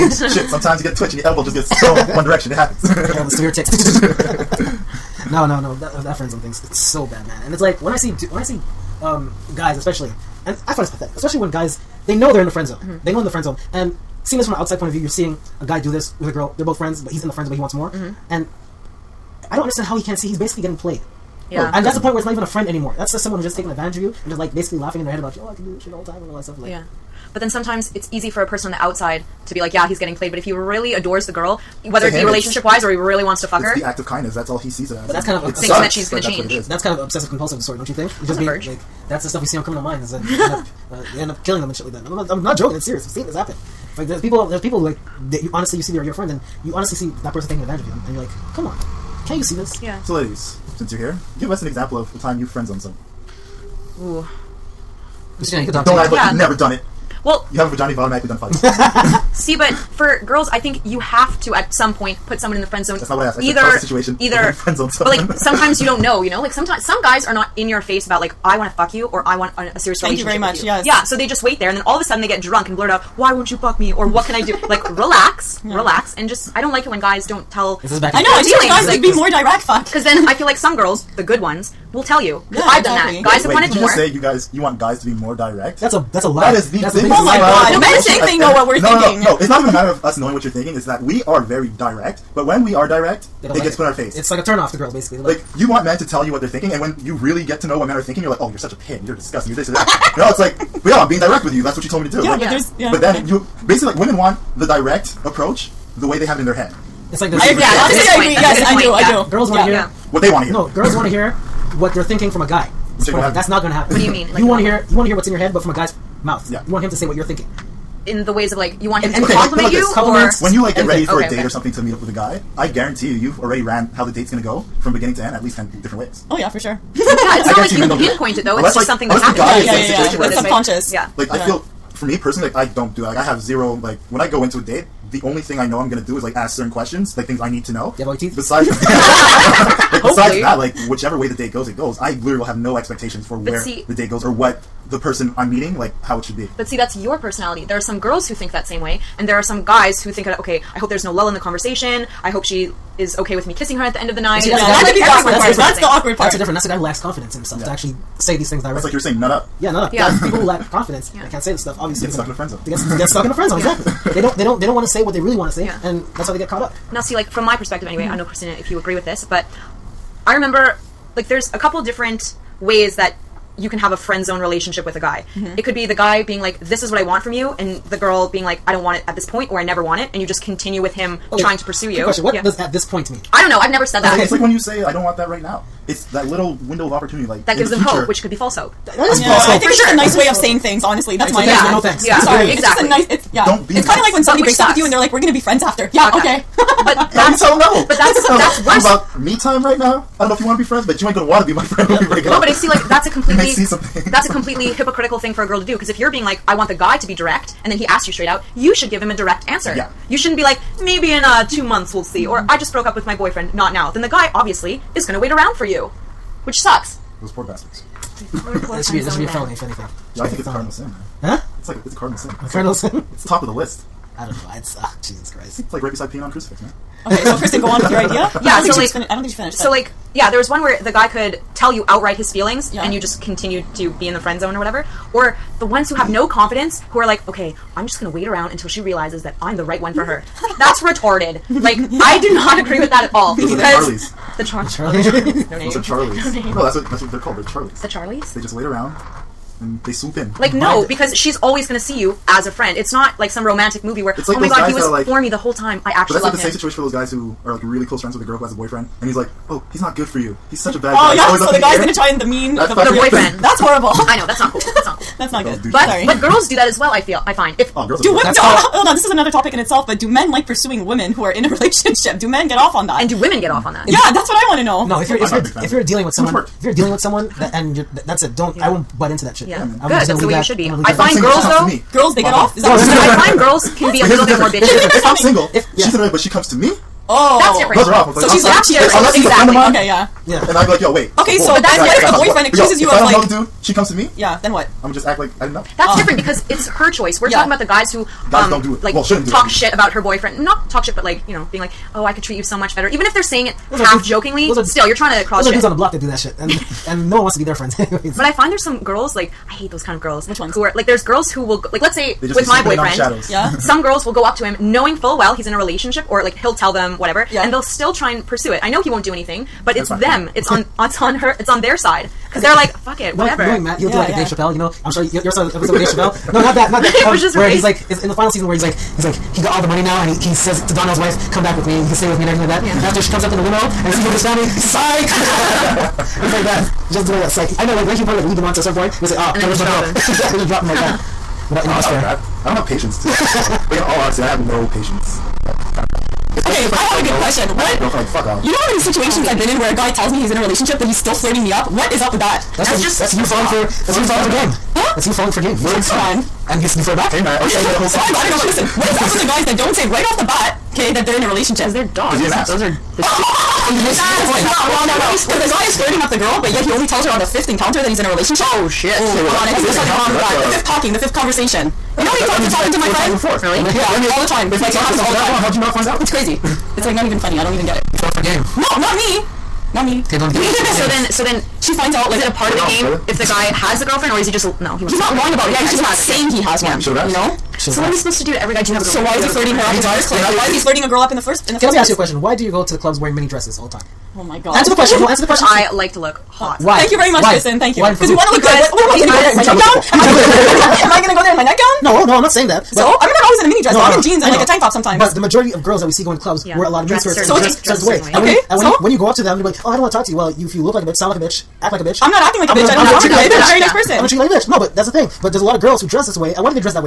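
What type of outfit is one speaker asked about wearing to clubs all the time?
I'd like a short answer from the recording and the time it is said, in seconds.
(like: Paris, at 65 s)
mini dresses, at 393 s.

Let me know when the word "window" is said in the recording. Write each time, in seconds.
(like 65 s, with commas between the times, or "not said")
186 s.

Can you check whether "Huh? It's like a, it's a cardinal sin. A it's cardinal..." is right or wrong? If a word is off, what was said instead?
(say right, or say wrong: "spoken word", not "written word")
right.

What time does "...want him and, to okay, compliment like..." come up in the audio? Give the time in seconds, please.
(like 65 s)
118 s.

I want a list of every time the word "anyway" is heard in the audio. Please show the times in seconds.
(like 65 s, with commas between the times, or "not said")
167 s, 307 s.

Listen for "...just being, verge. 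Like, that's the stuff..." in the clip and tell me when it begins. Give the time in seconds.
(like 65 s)
38 s.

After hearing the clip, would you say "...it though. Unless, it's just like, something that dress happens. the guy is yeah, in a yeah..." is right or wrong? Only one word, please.
wrong.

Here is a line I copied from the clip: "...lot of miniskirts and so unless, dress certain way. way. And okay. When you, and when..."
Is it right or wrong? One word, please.
wrong.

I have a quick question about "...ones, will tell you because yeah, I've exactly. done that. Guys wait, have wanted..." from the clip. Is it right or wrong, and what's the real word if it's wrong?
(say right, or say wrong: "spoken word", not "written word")
right.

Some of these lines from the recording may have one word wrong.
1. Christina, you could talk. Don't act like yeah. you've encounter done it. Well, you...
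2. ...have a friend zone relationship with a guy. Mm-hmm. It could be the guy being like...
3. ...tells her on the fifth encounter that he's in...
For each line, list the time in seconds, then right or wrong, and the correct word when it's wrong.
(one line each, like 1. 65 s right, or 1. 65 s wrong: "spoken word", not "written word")
1. 55 s wrong: "never", not "encounter"
2. 173 s right
3. 366 s right.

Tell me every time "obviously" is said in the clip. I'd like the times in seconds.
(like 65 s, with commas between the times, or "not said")
161 s, 214 s.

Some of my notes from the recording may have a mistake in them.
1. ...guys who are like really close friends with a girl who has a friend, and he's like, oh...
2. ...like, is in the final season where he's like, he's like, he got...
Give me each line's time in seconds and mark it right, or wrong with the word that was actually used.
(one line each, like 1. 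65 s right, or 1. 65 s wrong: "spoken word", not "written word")
1. 256 s wrong: "boyfriend", not "friend"
2. 327 s right.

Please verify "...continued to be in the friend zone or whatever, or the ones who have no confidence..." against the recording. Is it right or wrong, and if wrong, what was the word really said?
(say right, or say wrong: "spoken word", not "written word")
right.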